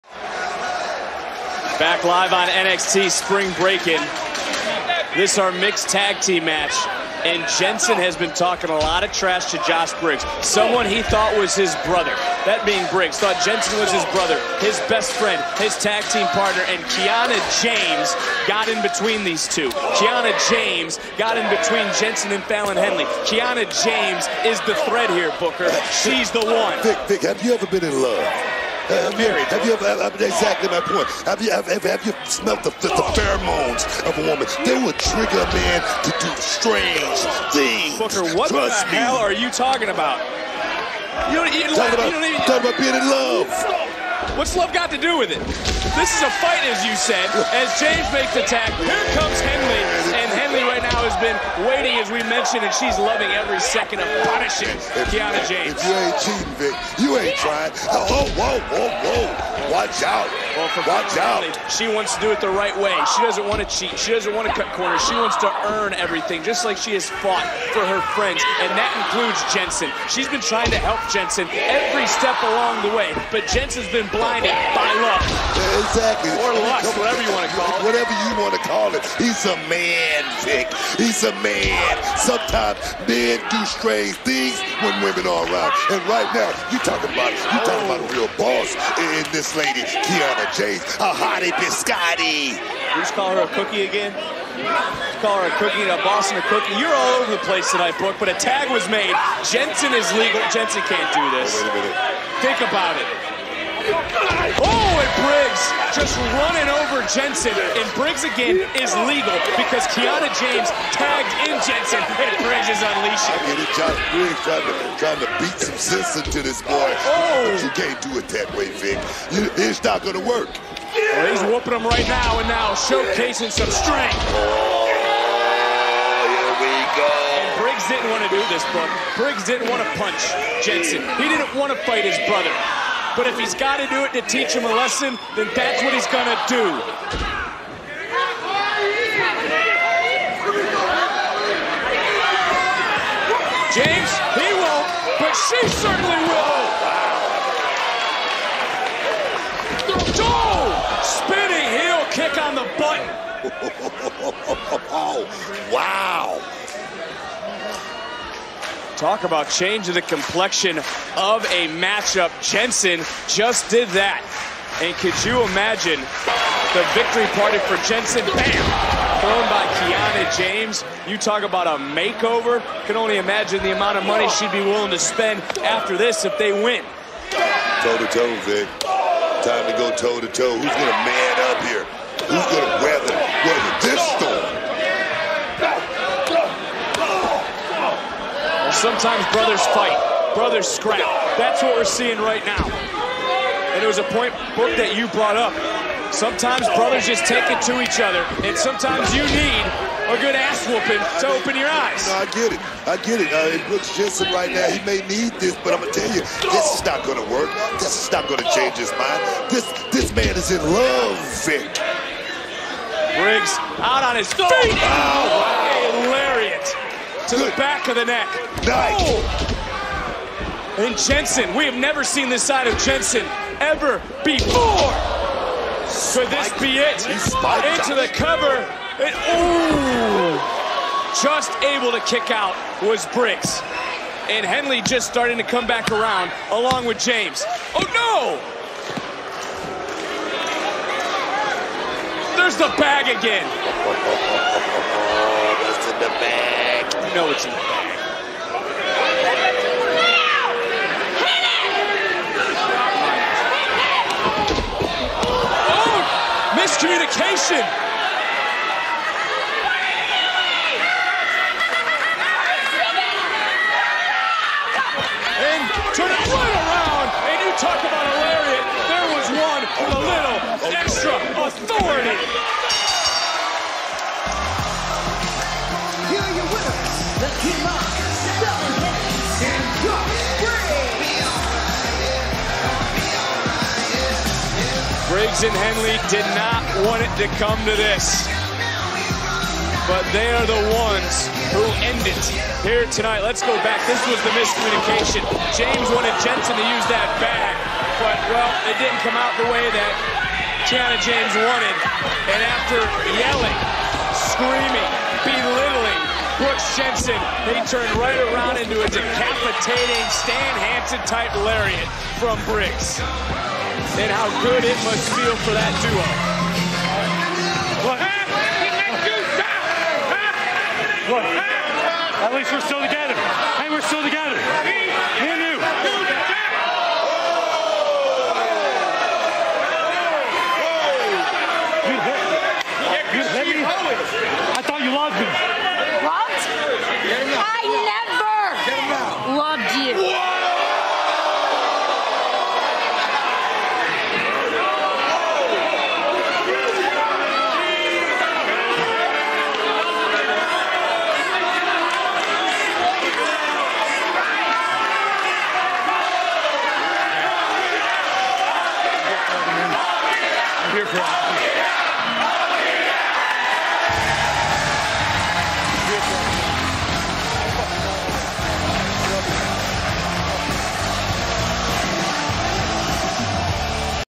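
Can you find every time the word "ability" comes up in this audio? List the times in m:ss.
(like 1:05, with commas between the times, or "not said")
not said.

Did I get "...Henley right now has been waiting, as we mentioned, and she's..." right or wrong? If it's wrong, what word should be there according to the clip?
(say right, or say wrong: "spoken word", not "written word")
right.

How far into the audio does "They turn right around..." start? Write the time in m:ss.
5:07.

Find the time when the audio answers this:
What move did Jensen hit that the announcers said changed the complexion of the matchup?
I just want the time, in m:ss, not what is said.
2:31.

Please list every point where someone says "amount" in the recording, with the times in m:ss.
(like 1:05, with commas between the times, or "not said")
2:53.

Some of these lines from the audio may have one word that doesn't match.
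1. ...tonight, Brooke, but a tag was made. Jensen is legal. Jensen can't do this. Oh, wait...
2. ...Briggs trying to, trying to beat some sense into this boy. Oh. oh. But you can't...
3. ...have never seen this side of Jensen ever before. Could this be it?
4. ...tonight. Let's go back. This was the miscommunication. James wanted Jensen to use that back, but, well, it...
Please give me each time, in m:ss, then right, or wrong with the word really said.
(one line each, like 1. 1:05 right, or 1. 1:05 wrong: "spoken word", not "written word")
1. 1:37 right
2. 1:54 right
3. 3:41 right
4. 4:52 right.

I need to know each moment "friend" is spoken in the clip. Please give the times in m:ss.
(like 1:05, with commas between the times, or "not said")
0:15, 1:08.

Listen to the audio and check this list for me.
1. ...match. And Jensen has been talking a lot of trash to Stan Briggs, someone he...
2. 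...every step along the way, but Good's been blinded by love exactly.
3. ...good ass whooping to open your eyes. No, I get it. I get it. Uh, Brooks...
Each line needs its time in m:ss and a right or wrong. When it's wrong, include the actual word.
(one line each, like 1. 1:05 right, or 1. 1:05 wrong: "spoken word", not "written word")
1. 0:06 wrong: "Josh", not "Stan"
2. 1:11 wrong: "Jensen", not "Good"
3. 3:20 right.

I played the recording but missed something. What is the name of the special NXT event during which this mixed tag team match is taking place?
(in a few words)
Spring Breakin.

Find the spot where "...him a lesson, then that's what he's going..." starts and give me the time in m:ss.
2:14.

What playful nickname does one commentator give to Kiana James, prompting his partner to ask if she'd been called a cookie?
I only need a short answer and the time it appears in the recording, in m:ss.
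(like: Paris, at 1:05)
hottie biscotti, at 1:30.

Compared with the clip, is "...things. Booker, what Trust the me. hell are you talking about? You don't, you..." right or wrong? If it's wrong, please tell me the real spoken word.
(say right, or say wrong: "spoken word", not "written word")
right.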